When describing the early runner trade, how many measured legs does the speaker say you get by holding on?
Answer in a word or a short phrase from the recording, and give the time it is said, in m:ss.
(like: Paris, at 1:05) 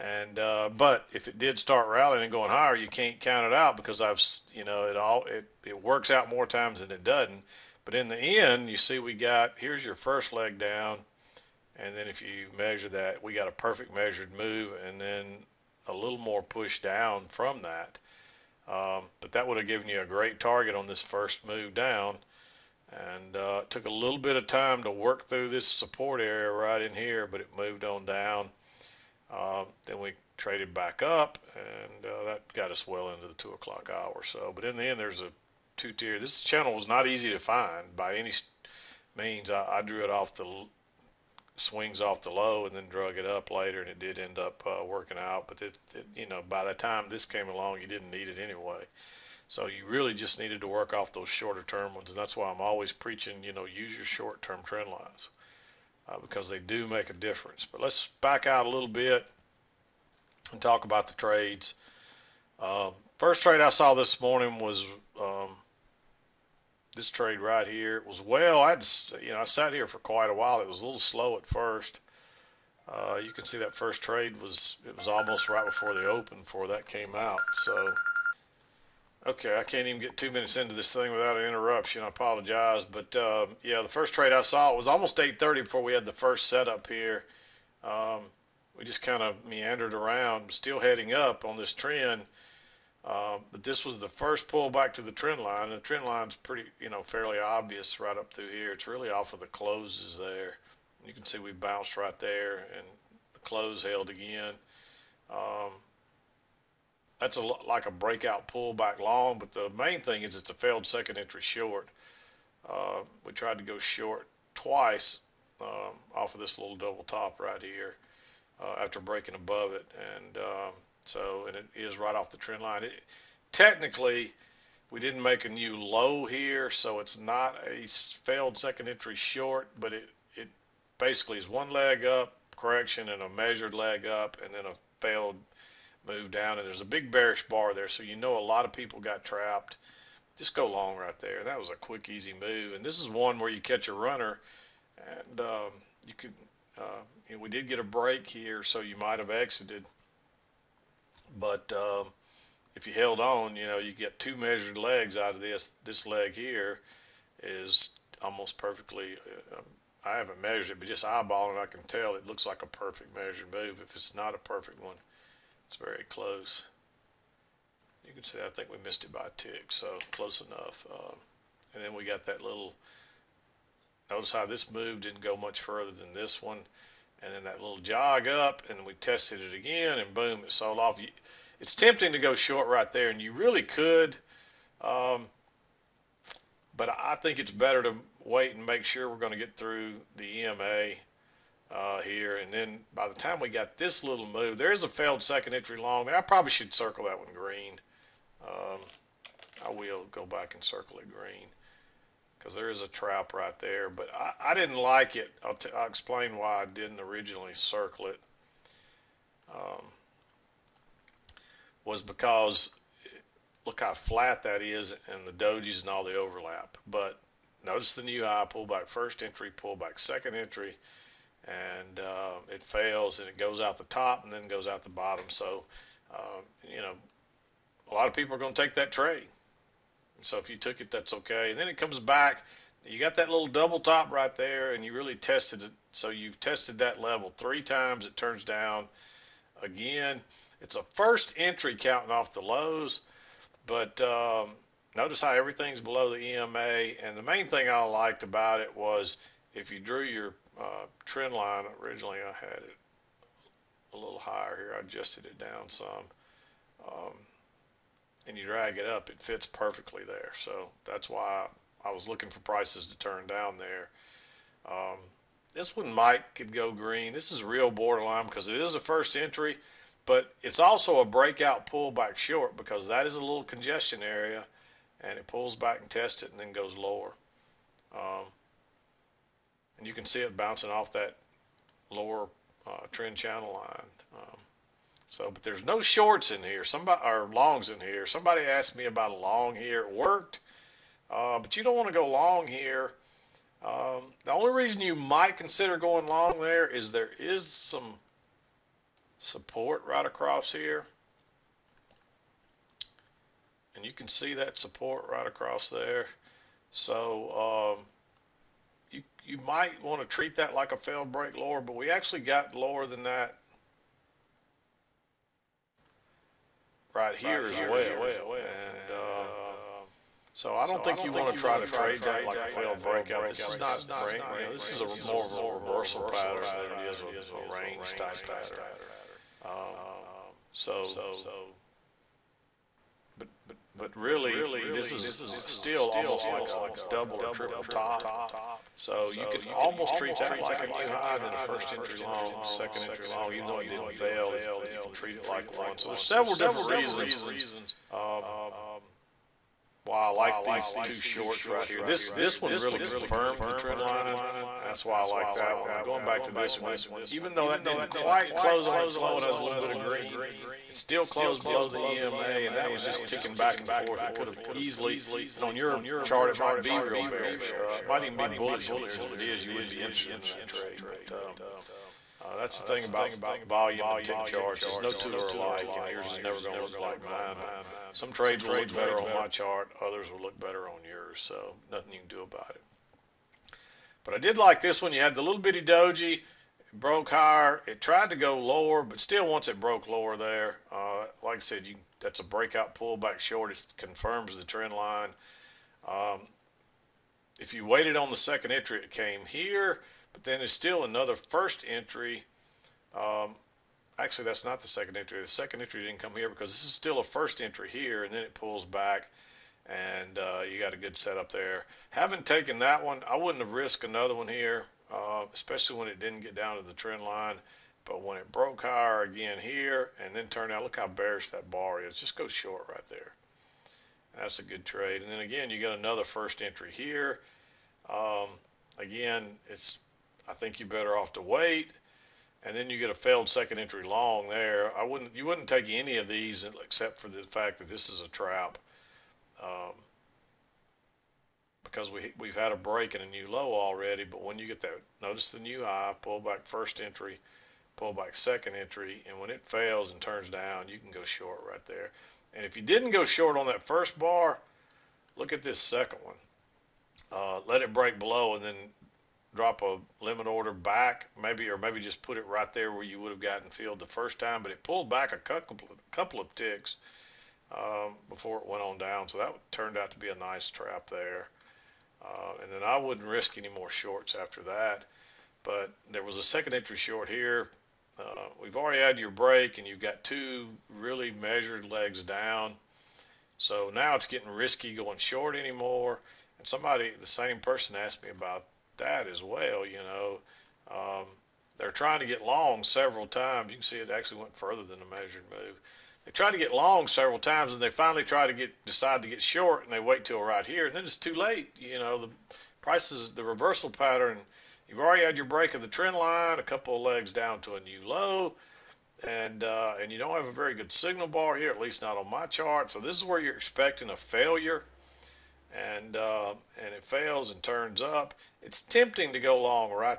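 2, at 2:34.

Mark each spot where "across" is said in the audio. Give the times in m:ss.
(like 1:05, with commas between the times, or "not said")
5:00, 5:05.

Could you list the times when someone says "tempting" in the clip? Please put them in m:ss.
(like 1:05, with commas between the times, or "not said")
3:01, 8:38.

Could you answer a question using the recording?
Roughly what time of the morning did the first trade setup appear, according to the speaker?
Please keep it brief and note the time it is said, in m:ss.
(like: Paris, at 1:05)
8:30, at 1:25.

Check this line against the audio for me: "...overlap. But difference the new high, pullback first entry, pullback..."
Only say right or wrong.
wrong.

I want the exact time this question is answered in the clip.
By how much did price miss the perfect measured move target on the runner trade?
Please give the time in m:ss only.
2:49.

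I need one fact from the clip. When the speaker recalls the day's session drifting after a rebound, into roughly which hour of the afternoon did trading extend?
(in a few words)
2 o'clock hour.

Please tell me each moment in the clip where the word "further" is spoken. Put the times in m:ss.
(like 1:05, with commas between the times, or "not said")
2:55, 8:14.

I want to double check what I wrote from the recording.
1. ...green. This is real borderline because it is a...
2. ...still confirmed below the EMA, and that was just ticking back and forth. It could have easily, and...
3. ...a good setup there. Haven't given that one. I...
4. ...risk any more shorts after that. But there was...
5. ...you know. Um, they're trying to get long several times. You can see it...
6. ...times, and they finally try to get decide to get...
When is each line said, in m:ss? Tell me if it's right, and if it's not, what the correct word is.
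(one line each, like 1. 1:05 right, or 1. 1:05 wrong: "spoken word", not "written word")
1. 4:26 right
2. 6:00 wrong: "closed", not "confirmed"
3. 6:50 wrong: "taken", not "given"
4. 7:53 right
5. 8:09 right
6. 8:17 right.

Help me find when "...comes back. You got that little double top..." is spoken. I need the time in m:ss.
3:51.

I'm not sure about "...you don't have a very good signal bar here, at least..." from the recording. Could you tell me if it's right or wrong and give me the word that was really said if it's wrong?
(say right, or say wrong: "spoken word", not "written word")
right.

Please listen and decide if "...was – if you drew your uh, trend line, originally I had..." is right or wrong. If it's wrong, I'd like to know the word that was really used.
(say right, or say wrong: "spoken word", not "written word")
right.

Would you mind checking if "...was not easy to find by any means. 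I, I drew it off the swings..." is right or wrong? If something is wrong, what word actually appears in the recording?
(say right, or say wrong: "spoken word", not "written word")
right.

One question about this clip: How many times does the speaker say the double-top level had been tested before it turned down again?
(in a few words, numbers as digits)
3.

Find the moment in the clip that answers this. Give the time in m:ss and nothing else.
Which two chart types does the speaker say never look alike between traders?
6:13.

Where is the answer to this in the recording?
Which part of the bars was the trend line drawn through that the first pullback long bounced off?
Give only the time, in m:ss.
1:39.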